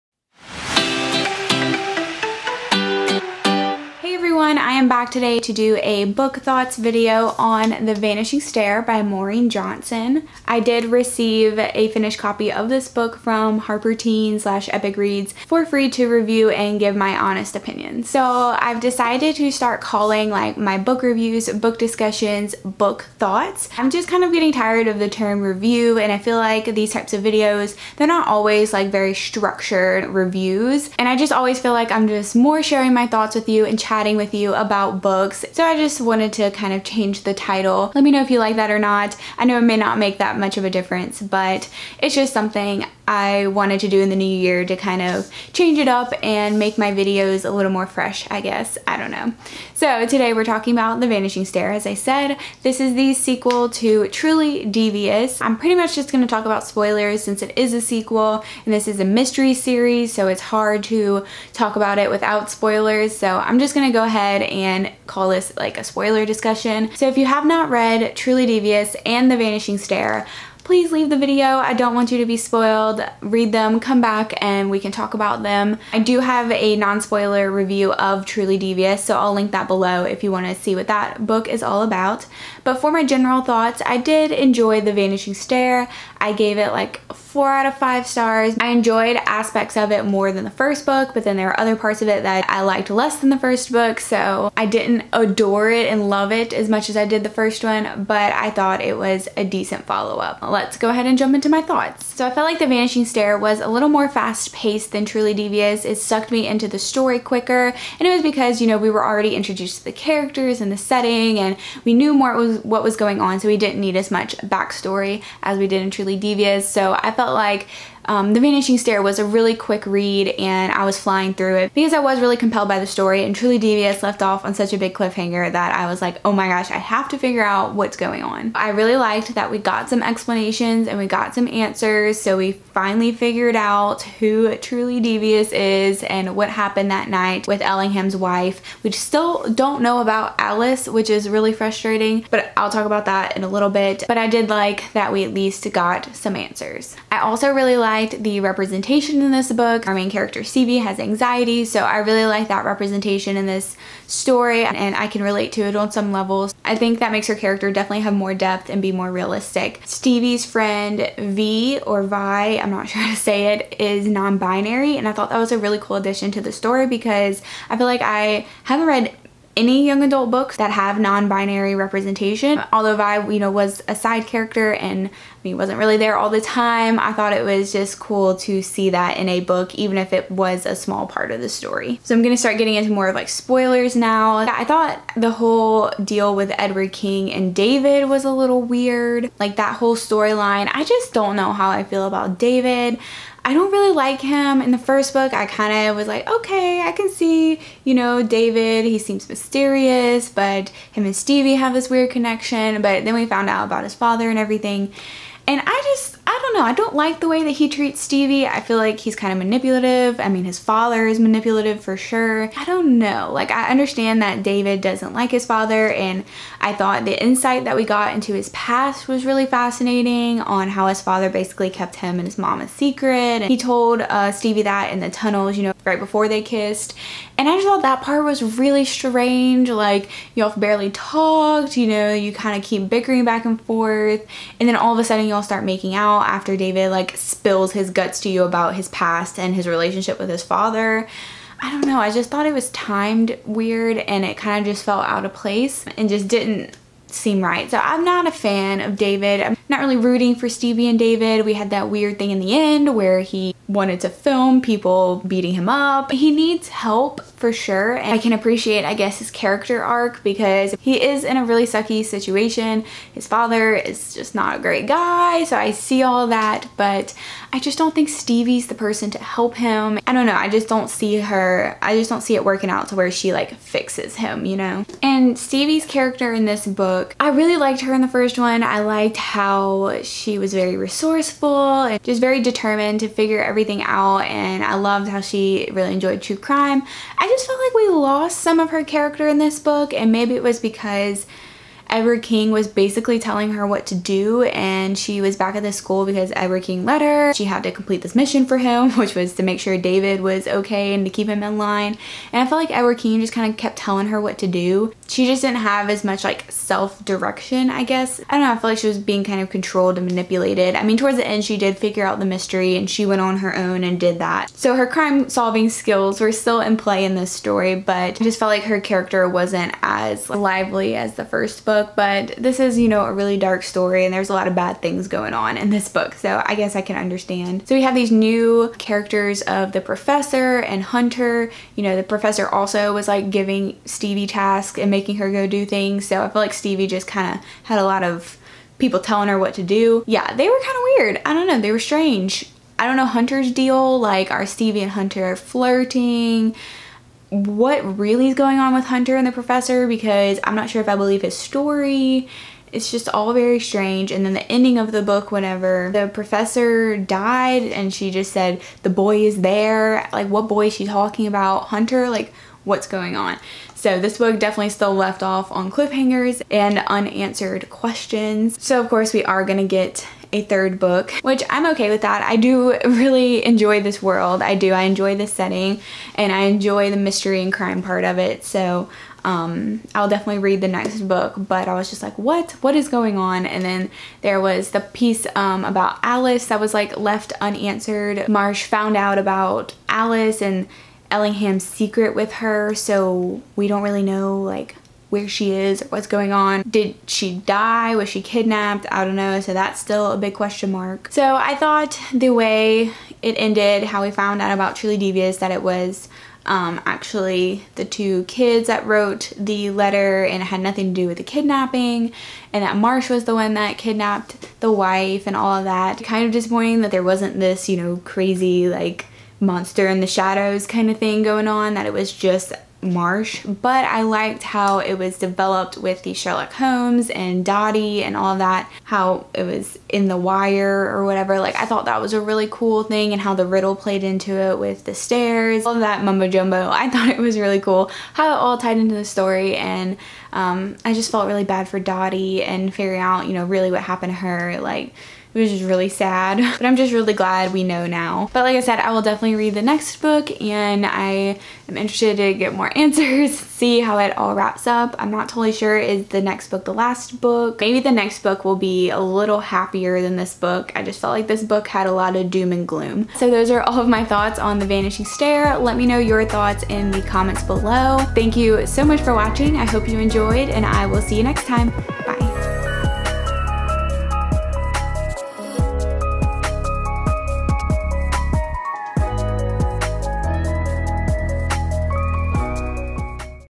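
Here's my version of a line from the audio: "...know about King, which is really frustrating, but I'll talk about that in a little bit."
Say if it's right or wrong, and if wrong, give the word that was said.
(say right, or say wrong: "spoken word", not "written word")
wrong: "Alice", not "King".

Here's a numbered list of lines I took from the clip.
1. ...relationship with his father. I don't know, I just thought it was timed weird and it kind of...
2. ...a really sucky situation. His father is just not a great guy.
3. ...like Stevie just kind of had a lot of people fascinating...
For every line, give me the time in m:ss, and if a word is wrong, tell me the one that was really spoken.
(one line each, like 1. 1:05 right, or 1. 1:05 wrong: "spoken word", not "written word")
1. 3:59 right
2. 4:21 right
3. 5:36 wrong: "telling", not "fascinating".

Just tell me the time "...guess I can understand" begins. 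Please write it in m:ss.
5:26.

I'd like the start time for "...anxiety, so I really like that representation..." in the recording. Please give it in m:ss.
2:30.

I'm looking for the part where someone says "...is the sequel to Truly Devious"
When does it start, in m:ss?
0:52.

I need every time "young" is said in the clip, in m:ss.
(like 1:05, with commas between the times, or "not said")
2:49.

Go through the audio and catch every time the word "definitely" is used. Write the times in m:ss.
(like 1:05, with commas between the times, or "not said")
2:37, 6:04, 6:20, 7:29.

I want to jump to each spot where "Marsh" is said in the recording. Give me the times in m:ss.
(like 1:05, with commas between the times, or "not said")
6:28, 6:52, 7:02.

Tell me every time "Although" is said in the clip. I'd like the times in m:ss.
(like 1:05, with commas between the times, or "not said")
2:52.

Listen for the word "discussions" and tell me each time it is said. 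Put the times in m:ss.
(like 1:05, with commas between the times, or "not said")
0:21, 1:06.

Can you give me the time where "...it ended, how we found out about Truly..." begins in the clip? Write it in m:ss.
6:43.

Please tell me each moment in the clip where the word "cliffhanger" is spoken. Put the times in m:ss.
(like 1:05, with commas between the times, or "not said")
2:04, 6:05.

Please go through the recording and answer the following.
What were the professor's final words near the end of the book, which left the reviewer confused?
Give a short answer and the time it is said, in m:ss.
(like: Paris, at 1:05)
The boy is there, at 5:58.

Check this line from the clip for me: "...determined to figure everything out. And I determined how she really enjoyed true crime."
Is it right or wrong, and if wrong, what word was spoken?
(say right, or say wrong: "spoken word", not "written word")
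wrong: "loved", not "determined".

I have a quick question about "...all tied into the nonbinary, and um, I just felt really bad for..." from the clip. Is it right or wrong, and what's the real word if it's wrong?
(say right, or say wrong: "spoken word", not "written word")
wrong: "story", not "nonbinary".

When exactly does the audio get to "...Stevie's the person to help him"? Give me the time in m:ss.
4:28.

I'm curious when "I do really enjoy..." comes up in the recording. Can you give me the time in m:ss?
6:12.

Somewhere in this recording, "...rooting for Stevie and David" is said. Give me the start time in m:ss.
4:09.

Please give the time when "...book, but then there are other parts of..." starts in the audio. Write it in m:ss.
1:30.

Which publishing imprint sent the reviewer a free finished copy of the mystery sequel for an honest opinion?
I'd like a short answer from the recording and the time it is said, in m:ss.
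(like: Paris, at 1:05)
Harper Teen, at 0:13.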